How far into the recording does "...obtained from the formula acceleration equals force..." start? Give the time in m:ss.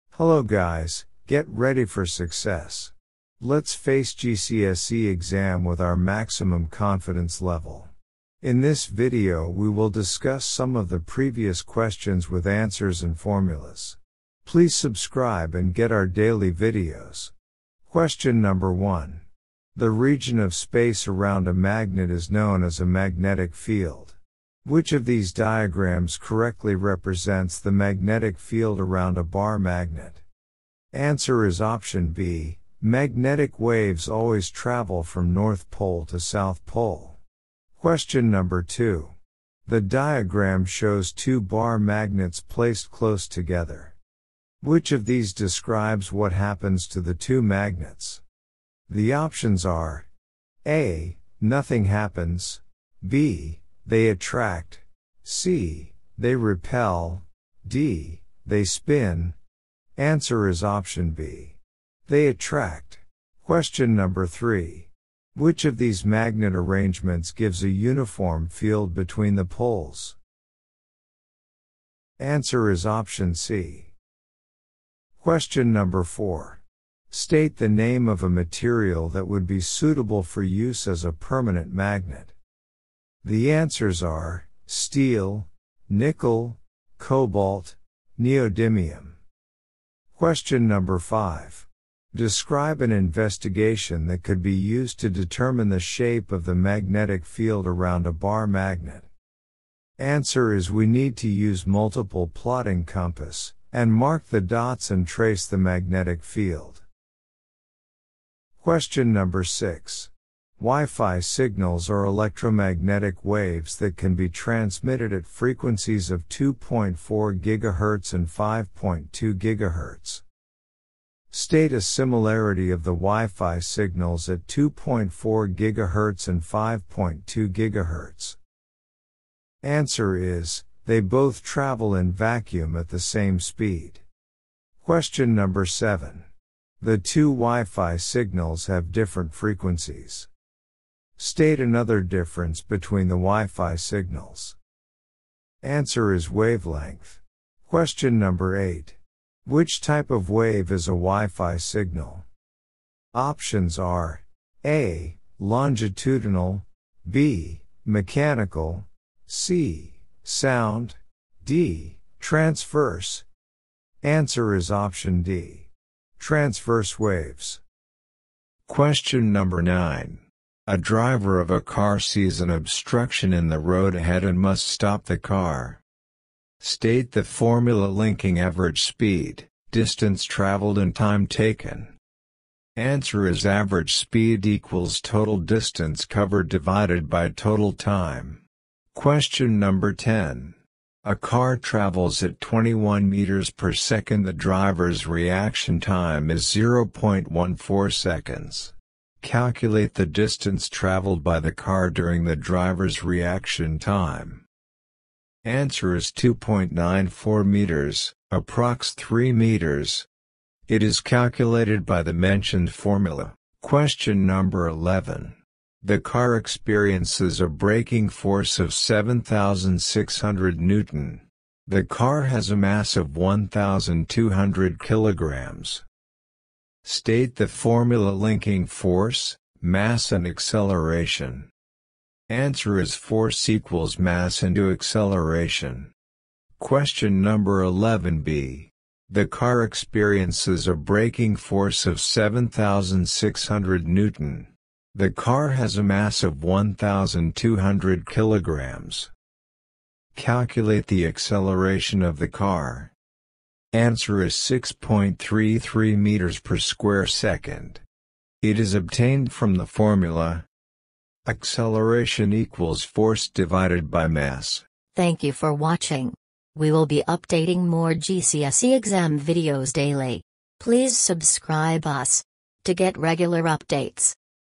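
4:18.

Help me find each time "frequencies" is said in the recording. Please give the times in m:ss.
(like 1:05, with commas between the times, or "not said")
1:55, 2:19.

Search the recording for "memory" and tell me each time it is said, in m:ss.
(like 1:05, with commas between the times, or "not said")
not said.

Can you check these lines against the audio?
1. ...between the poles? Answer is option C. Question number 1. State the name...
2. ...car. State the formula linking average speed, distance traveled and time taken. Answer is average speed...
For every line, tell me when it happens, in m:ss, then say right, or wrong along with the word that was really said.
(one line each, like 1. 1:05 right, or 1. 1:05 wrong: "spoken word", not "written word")
1. 1:08 wrong: "4", not "1"
2. 2:55 right.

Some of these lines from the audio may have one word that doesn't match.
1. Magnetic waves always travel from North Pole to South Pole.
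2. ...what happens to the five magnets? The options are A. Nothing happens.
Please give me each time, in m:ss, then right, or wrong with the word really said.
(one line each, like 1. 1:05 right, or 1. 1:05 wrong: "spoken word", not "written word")
1. 0:32 right
2. 0:46 wrong: "two", not "five".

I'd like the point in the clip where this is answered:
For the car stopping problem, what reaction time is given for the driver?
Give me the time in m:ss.
3:16.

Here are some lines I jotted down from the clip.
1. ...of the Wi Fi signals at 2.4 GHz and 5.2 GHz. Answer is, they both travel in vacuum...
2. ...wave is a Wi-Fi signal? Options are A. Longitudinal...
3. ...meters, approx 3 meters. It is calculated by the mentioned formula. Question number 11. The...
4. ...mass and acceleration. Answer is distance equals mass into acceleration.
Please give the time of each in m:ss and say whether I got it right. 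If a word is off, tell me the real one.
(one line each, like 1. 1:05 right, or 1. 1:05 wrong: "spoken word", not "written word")
1. 2:02 right
2. 2:30 right
3. 3:27 right
4. 3:49 wrong: "force", not "distance".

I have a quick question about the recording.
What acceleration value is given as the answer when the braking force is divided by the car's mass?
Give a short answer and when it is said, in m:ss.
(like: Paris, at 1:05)
6.33 m/s², at 4:14.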